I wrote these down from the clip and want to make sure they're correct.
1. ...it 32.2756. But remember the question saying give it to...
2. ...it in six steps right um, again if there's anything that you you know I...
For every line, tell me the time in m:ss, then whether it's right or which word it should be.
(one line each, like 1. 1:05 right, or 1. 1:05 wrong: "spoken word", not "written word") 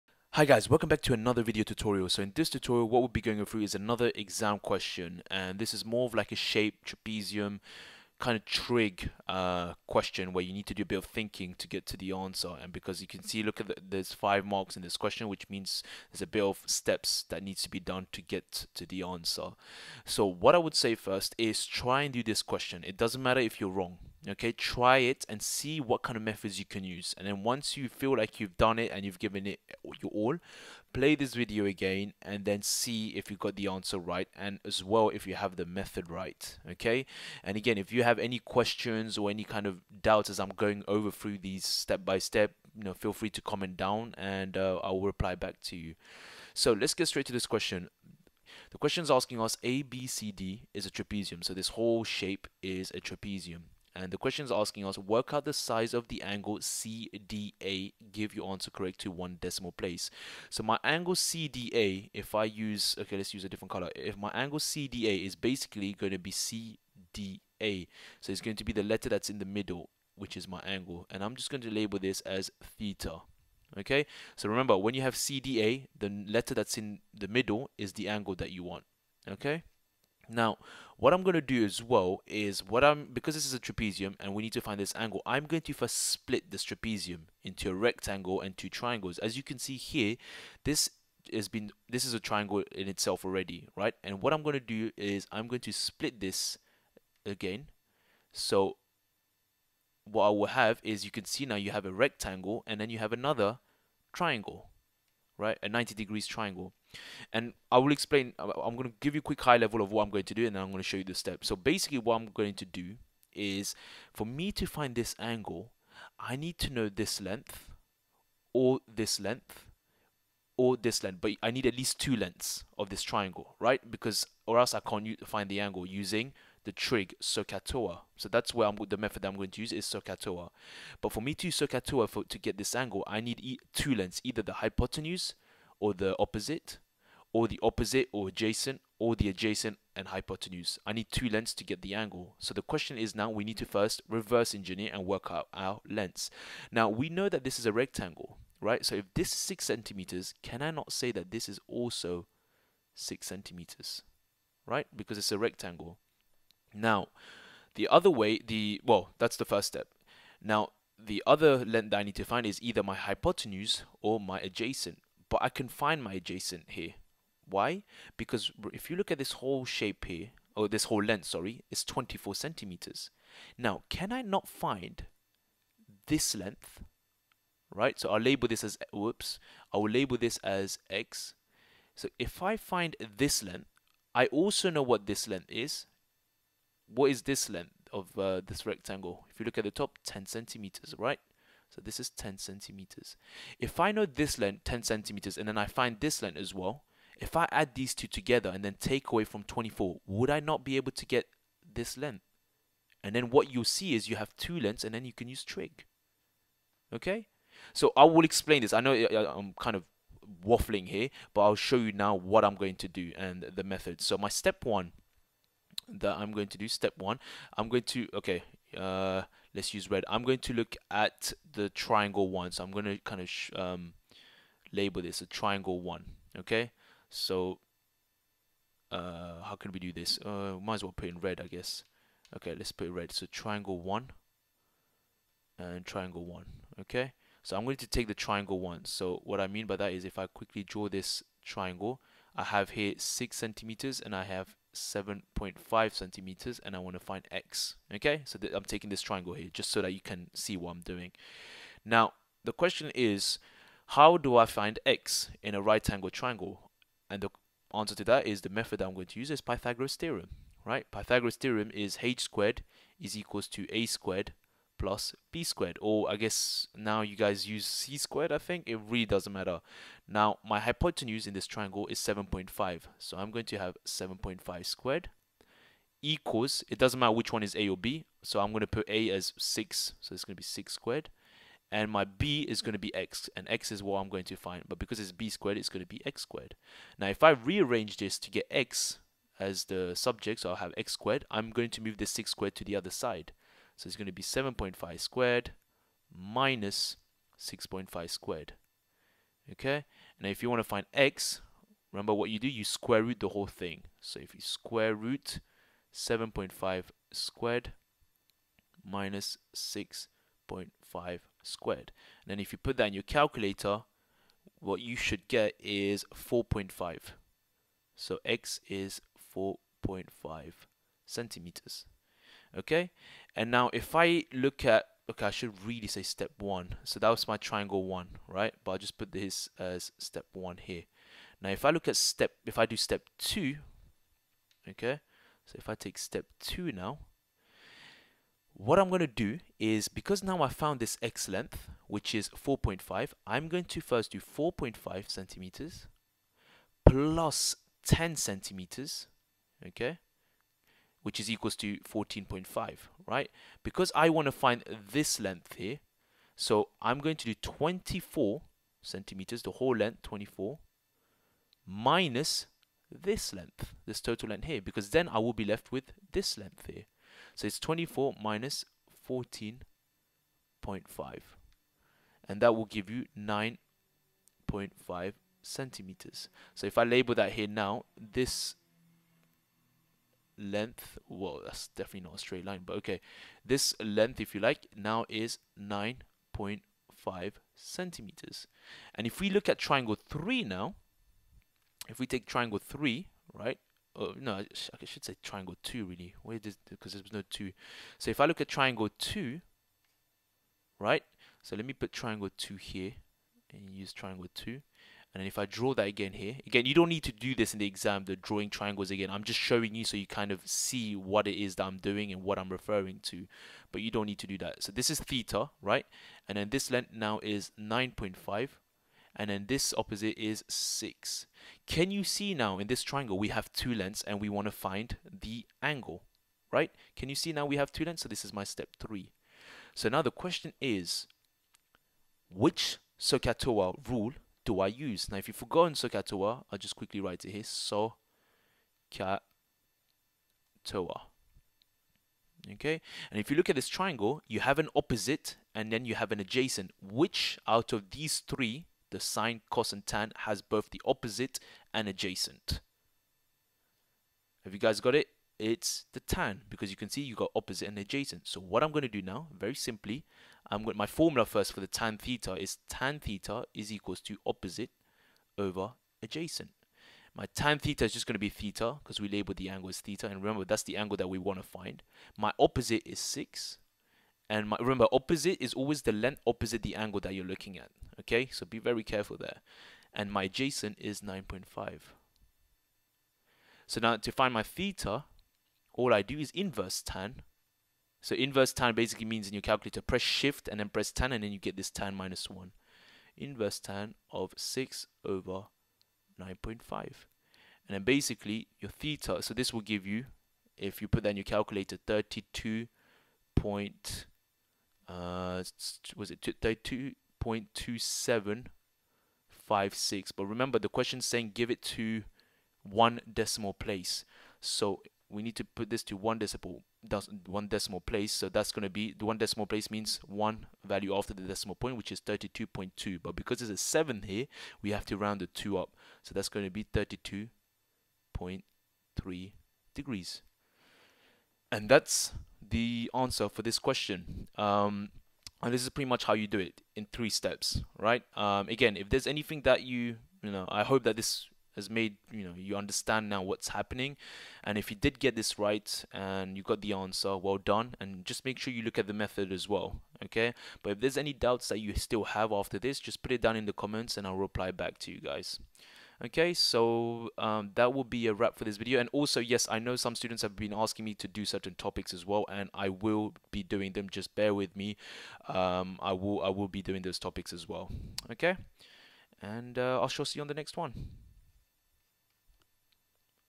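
1. 8:26 right
2. 8:56 wrong: "three", not "six".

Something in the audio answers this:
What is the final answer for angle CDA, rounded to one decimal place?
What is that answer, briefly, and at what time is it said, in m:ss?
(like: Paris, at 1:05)
32.3 degrees, at 8:46.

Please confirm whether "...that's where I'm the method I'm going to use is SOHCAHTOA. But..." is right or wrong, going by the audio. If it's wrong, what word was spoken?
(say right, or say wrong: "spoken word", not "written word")
right.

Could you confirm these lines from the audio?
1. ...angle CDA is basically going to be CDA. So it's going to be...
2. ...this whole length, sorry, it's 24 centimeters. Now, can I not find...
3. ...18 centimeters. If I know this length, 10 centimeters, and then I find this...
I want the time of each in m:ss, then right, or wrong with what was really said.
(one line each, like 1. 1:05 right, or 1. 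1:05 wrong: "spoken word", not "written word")
1. 1:04 right
2. 2:50 right
3. 3:12 wrong: "10", not "18".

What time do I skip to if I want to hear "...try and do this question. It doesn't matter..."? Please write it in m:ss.
0:21.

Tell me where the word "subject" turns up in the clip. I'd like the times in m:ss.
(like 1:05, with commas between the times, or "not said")
4:49.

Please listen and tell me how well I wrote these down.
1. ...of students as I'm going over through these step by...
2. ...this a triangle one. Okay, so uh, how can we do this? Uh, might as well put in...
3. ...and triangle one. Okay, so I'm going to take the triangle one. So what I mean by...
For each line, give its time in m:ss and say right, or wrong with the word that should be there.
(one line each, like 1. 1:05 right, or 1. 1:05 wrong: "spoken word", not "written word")
1. 0:39 wrong: "doubts", not "students"
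2. 3:45 right
3. 3:55 right.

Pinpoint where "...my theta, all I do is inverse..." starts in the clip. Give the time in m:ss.
8:04.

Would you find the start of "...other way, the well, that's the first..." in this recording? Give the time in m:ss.
2:37.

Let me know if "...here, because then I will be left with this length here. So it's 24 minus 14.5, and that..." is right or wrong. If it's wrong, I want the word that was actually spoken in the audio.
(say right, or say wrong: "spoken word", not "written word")
right.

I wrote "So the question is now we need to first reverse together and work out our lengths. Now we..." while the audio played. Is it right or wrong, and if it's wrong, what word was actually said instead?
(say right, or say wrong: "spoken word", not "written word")
wrong: "engineer", not "together".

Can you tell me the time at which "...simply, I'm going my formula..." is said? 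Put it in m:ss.
7:39.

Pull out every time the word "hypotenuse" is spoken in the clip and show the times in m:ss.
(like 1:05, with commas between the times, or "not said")
2:14, 2:20, 2:42, 4:30.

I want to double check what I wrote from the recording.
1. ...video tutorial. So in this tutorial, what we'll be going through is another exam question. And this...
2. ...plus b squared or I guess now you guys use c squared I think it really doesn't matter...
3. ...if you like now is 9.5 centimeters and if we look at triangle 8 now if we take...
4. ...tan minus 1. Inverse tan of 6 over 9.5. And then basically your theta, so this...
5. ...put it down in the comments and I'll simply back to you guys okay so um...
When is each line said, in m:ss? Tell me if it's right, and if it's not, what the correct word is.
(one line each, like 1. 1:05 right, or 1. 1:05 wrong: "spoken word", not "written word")
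1. 0:01 right
2. 4:24 right
3. 6:24 wrong: "3", not "8"
4. 8:11 right
5. 9:13 wrong: "reply", not "simply".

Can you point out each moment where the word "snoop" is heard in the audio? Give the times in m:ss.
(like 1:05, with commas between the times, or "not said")
not said.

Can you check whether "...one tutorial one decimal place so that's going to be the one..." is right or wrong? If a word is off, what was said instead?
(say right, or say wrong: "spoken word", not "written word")
wrong: "decimal", not "tutorial".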